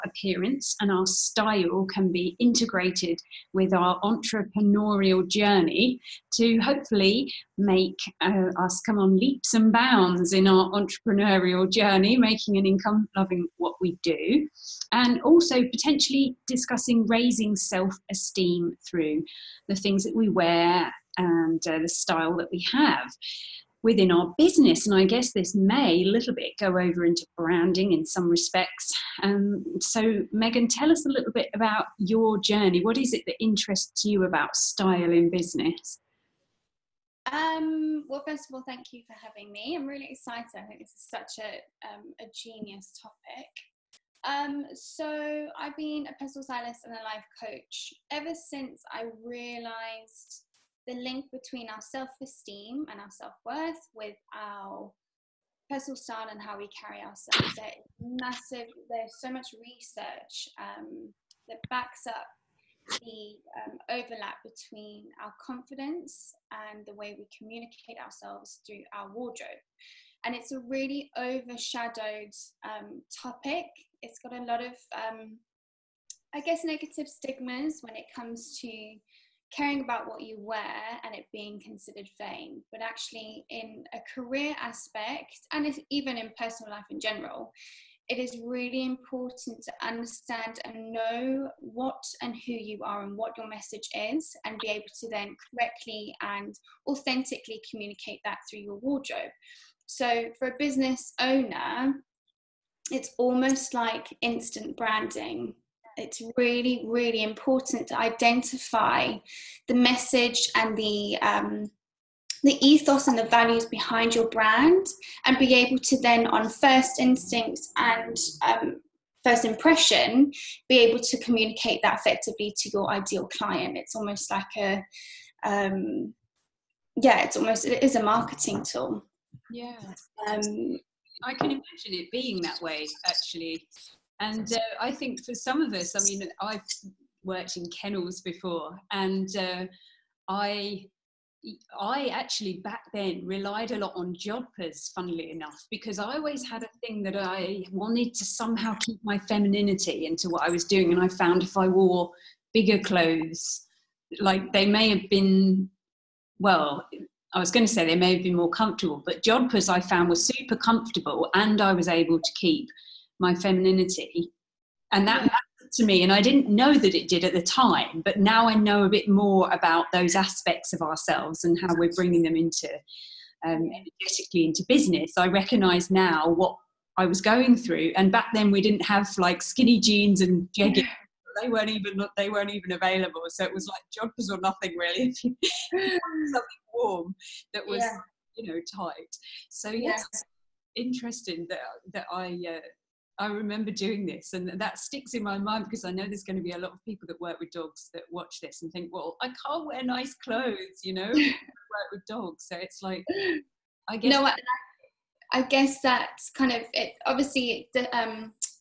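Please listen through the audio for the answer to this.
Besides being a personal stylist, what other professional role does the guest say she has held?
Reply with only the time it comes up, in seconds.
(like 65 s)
47 s.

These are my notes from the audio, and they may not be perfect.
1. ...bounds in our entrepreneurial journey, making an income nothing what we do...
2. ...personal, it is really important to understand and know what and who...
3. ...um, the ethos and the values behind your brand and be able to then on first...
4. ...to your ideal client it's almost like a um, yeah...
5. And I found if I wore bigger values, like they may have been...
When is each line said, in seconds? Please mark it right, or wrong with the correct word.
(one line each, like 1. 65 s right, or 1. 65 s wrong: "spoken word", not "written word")
1. 9 s wrong: "loving", not "nothing"
2. 87 s wrong: "general", not "personal"
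3. 111 s right
4. 122 s right
5. 150 s wrong: "clothes", not "values".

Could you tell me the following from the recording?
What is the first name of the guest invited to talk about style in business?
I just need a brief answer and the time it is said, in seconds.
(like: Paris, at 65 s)
Megan, at 30 s.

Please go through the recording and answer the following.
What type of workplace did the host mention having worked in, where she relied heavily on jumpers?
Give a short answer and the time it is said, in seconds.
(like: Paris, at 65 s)
kennels, at 137 s.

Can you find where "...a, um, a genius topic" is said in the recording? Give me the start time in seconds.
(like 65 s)
41 s.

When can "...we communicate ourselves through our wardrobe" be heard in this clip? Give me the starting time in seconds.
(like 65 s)
67 s.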